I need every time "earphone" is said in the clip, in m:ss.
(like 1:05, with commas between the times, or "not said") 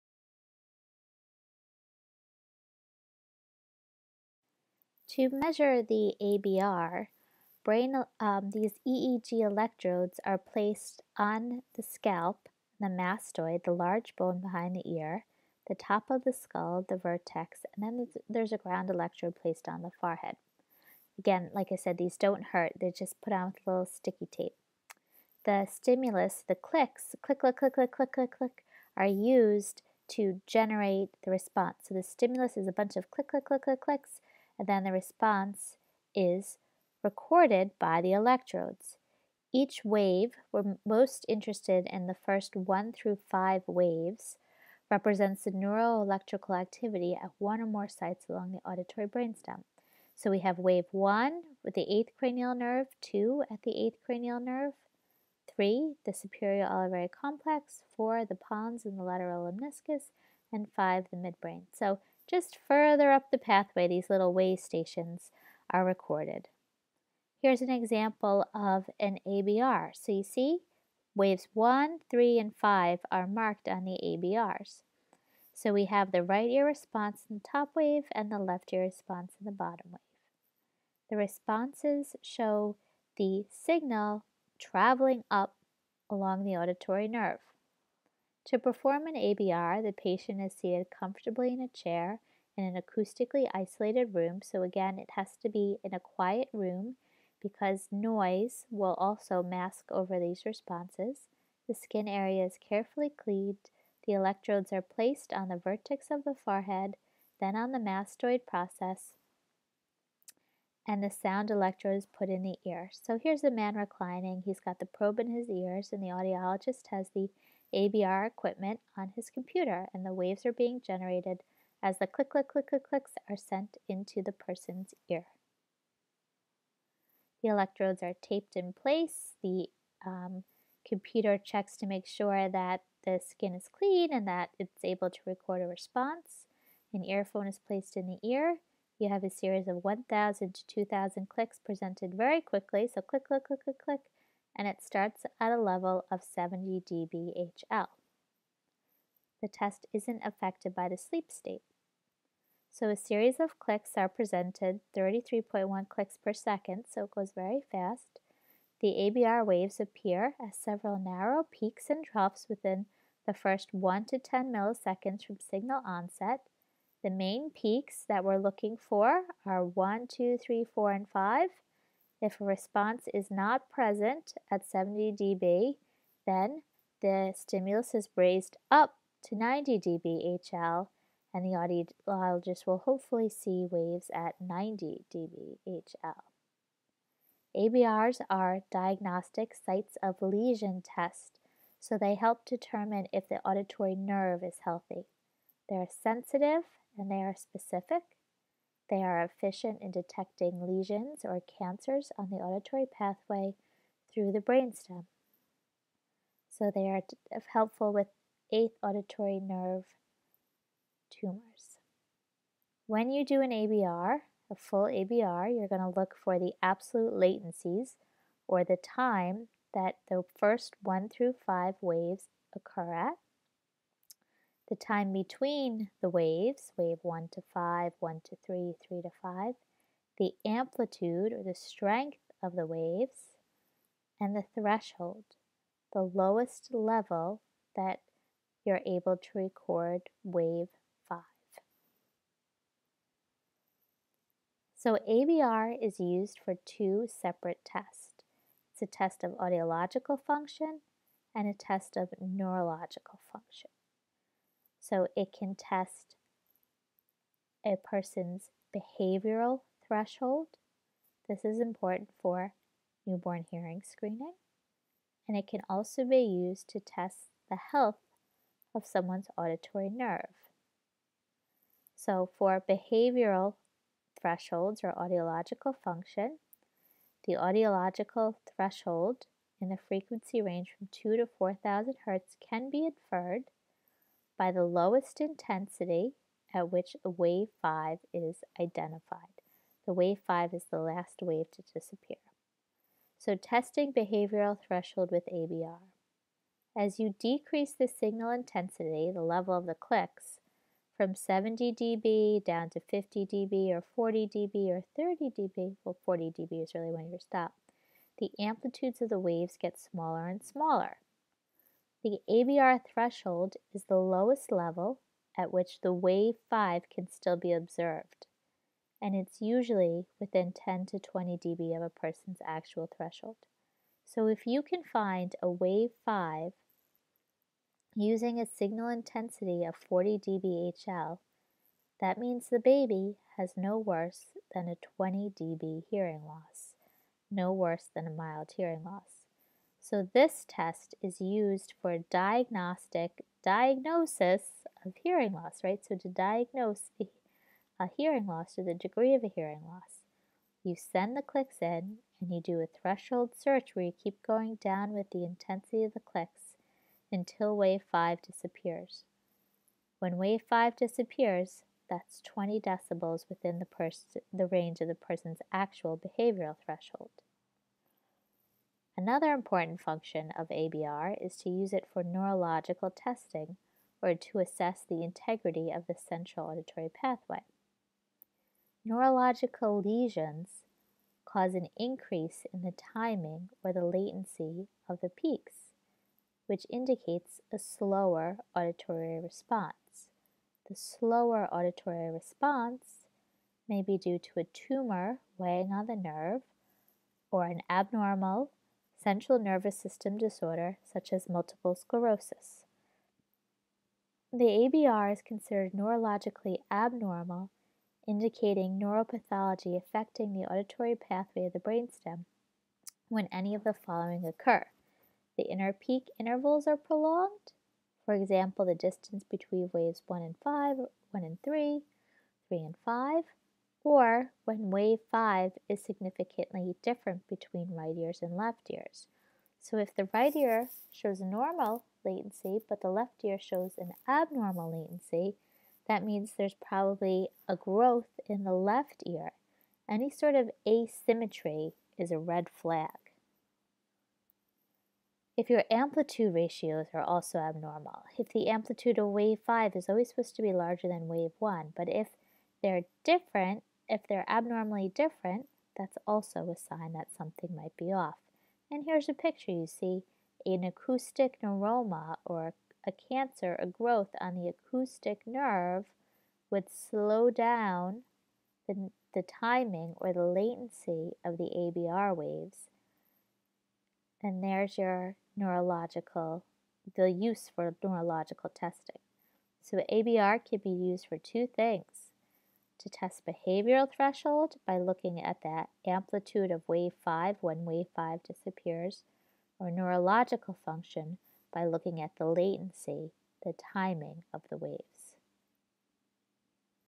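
2:17.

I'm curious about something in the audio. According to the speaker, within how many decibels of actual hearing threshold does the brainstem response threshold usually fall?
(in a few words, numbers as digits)
10 to 20 dB.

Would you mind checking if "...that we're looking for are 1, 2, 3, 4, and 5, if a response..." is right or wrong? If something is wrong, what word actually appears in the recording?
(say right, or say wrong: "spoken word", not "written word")
right.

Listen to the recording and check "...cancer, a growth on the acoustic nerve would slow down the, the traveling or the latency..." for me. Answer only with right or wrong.
wrong.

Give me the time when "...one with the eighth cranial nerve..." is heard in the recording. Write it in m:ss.
0:50.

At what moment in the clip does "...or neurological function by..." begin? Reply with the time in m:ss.
8:09.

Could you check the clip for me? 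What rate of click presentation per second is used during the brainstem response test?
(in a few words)
33.1.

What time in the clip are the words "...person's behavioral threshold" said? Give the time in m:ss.
4:17.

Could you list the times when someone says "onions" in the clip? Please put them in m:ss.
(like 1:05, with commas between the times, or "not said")
not said.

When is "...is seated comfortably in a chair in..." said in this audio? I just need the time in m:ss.
1:30.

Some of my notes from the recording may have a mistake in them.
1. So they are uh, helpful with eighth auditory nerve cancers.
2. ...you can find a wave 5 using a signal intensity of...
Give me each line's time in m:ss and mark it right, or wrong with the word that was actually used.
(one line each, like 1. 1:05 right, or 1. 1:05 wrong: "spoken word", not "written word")
1. 3:26 wrong: "tumors", not "cancers"
2. 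5:24 right.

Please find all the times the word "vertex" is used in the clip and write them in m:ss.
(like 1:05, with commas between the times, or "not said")
0:16, 1:45.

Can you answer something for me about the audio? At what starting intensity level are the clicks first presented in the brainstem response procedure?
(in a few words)
70 dBHL.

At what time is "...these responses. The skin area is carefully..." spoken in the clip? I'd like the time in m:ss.
1:40.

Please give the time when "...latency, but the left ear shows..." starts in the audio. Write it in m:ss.
7:12.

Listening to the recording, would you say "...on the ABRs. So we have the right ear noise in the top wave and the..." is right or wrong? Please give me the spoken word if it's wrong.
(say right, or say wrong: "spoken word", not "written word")
wrong: "response", not "noise".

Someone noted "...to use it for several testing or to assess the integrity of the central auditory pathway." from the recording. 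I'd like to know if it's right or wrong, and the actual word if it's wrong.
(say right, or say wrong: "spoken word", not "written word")
wrong: "neurological", not "several".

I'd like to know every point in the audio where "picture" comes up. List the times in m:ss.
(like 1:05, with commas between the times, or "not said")
7:39.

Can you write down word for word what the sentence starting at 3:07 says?
ABRs are diagnostic sites of lesion test, so they help determine if the auditory nerve is healthy.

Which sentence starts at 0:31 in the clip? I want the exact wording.
So the stimulus is a bunch of click, click, click, click, clicks then the response is recorded by the electrodes.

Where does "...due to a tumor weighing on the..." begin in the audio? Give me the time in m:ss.
6:33.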